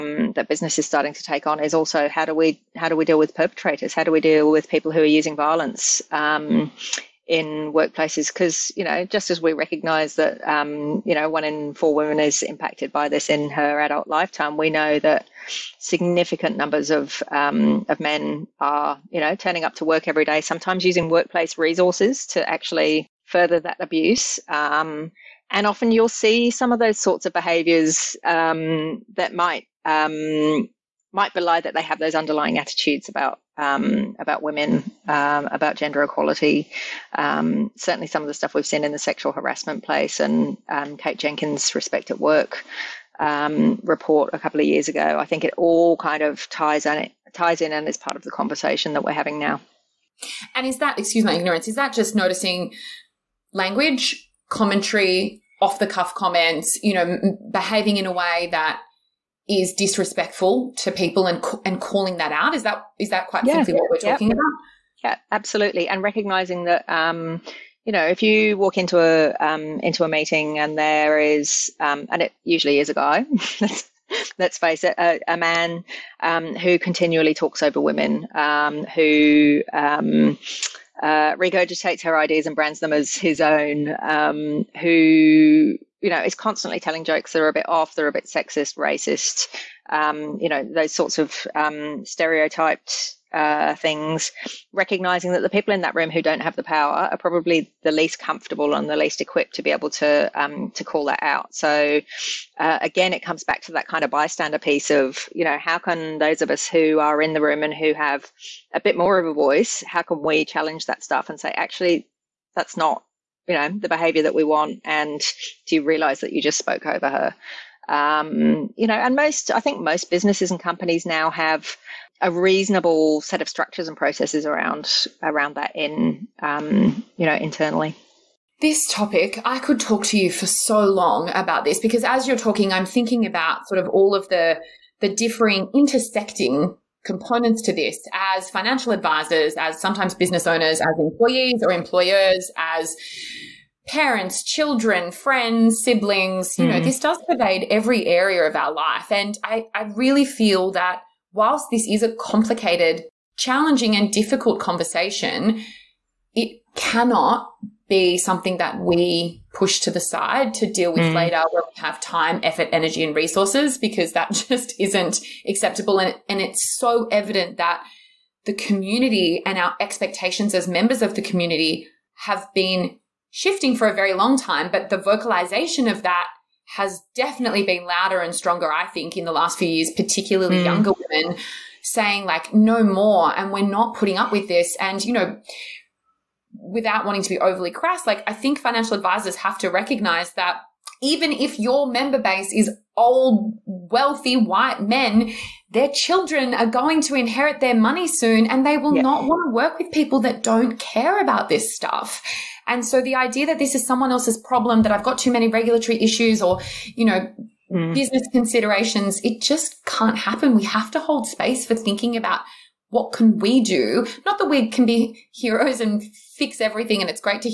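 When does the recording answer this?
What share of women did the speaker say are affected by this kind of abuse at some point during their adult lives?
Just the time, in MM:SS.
00:11.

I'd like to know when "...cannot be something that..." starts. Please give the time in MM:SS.
02:36.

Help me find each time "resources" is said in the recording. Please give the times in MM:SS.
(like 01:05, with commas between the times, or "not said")
00:21, 02:43.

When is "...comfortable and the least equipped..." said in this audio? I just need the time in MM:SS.
01:38.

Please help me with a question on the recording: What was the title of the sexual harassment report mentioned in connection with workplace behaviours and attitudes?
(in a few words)
Respect at Work.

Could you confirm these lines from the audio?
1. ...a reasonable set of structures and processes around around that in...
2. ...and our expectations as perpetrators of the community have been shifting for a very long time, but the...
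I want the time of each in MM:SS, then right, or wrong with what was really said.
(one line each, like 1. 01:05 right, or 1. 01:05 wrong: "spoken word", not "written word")
1. 02:02 right
2. 02:49 wrong: "members", not "perpetrators".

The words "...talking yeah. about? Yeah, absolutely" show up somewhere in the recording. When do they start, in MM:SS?
01:03.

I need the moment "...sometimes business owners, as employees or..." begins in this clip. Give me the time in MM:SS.
02:19.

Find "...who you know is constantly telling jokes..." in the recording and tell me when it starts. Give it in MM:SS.
01:24.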